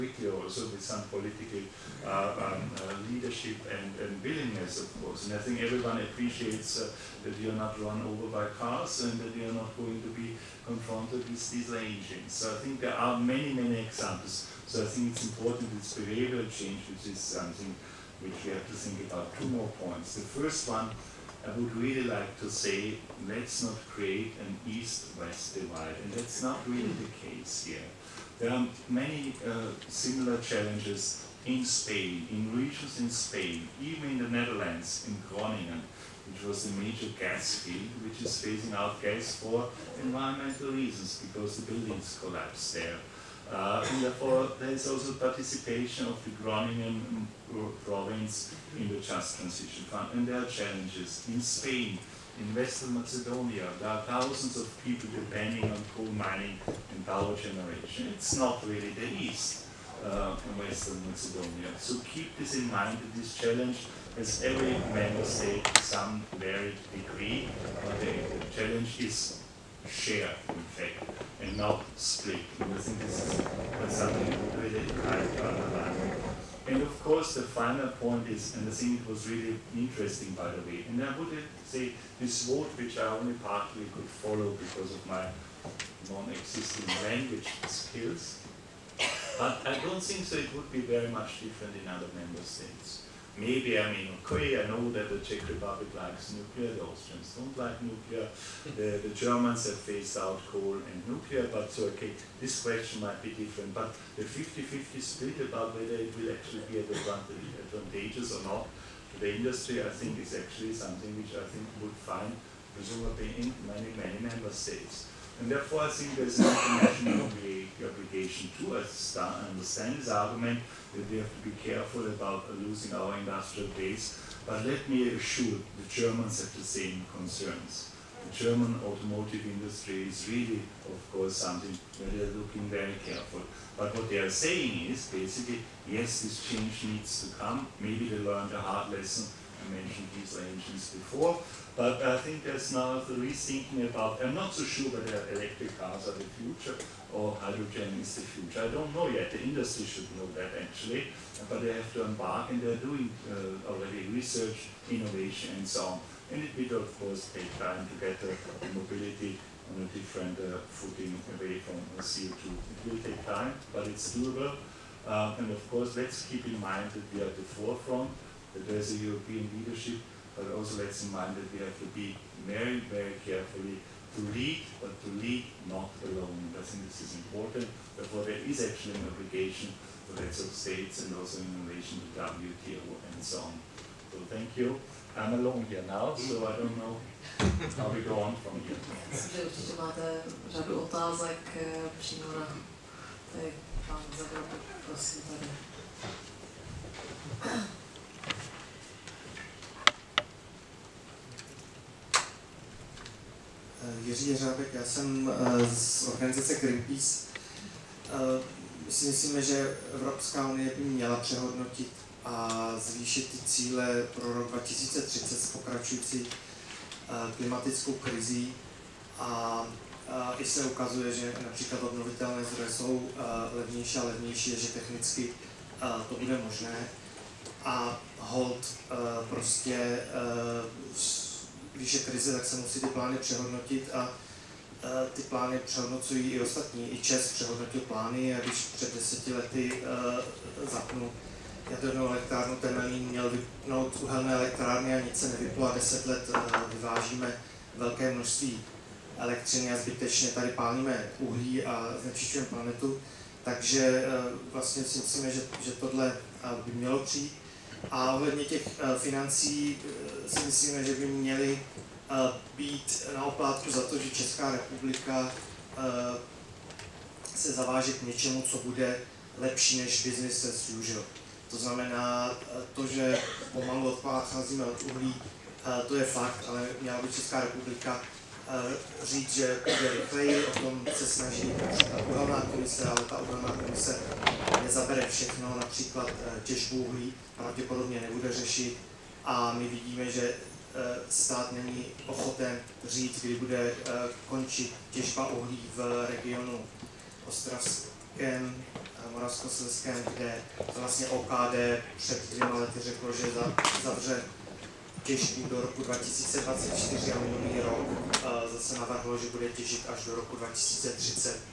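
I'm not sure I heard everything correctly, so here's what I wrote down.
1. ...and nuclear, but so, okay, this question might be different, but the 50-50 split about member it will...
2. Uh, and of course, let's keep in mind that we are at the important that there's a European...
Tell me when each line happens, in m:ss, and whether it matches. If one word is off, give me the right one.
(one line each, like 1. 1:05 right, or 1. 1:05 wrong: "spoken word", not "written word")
1. 1:40 wrong: "whether", not "member"
2. 2:45 wrong: "forefront", not "important".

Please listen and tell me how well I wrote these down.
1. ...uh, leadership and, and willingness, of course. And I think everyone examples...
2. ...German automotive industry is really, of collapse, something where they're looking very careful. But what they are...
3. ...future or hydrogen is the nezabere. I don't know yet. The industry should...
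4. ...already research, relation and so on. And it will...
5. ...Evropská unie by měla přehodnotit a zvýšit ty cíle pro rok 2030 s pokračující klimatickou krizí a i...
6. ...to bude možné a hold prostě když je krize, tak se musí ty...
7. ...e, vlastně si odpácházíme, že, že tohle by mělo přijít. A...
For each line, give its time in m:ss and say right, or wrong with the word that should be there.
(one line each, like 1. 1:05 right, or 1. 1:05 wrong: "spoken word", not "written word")
1. 0:02 wrong: "appreciates", not "examples"
2. 2:08 wrong: "course", not "collapse"
3. 2:26 wrong: "future", not "nezabere"
4. 2:33 wrong: "innovation", not "relation"
5. 3:29 right
6. 3:46 right
7. 4:13 wrong: "myslíme", not "odpácházíme".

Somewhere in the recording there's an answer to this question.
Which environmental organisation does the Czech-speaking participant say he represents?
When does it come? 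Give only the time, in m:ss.
3:26.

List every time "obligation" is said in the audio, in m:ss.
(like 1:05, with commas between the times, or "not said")
1:57, 2:59.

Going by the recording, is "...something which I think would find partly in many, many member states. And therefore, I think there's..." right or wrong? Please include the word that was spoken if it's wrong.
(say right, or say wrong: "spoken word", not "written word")
wrong: "presumably", not "partly".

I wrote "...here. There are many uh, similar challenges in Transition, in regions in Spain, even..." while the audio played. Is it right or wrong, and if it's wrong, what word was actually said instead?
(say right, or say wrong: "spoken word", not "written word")
wrong: "Spain", not "Transition".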